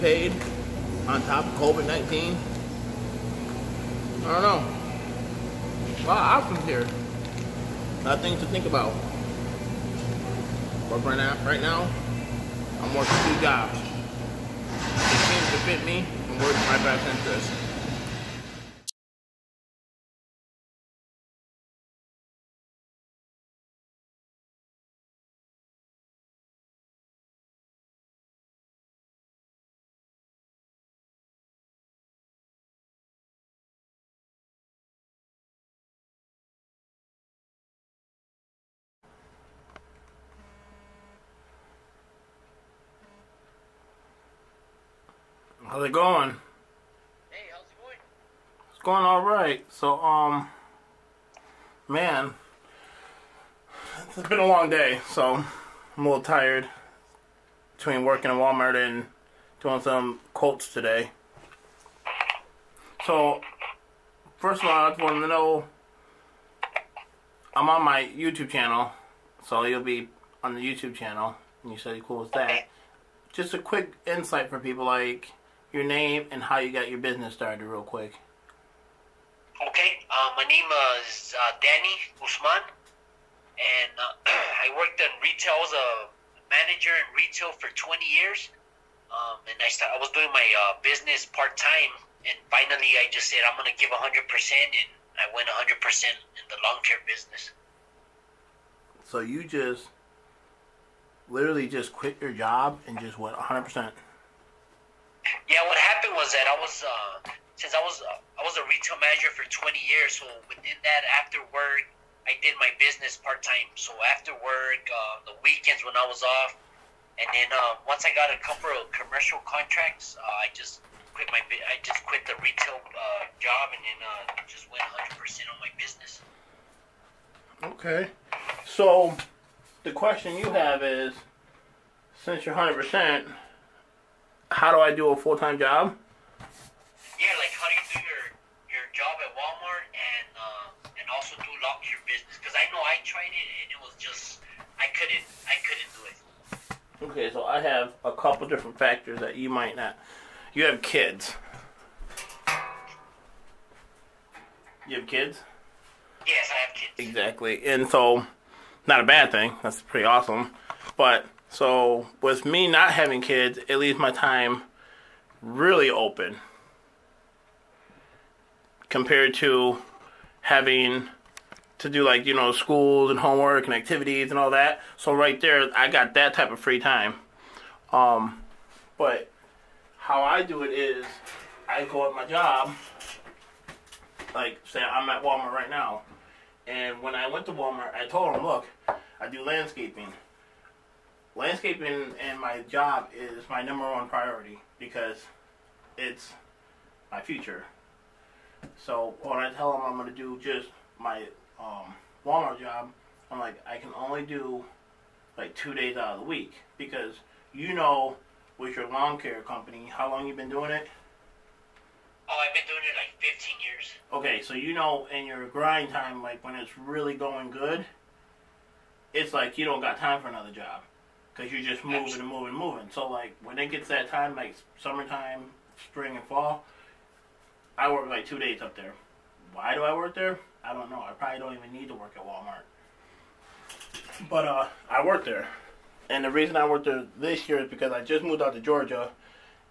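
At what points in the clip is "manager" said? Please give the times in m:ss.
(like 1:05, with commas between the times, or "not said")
1:26, 1:49.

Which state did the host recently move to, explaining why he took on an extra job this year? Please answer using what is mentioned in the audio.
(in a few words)
Georgia.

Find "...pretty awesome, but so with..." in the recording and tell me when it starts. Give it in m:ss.
2:39.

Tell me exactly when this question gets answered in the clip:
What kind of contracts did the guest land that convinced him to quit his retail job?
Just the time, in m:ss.
1:58.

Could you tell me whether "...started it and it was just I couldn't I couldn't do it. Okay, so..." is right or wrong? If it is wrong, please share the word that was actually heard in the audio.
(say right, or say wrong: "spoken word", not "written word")
wrong: "tried", not "started".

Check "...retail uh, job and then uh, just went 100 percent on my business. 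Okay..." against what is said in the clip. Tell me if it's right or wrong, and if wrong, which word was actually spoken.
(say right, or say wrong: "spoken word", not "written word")
right.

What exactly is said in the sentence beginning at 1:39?
So you just literally just quit your job and just went 100%.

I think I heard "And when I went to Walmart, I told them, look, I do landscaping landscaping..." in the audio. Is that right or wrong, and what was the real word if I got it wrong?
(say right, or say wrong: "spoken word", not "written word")
right.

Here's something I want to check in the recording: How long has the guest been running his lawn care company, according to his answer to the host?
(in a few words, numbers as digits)
15 years.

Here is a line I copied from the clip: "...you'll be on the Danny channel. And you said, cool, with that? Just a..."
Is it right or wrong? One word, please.
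wrong.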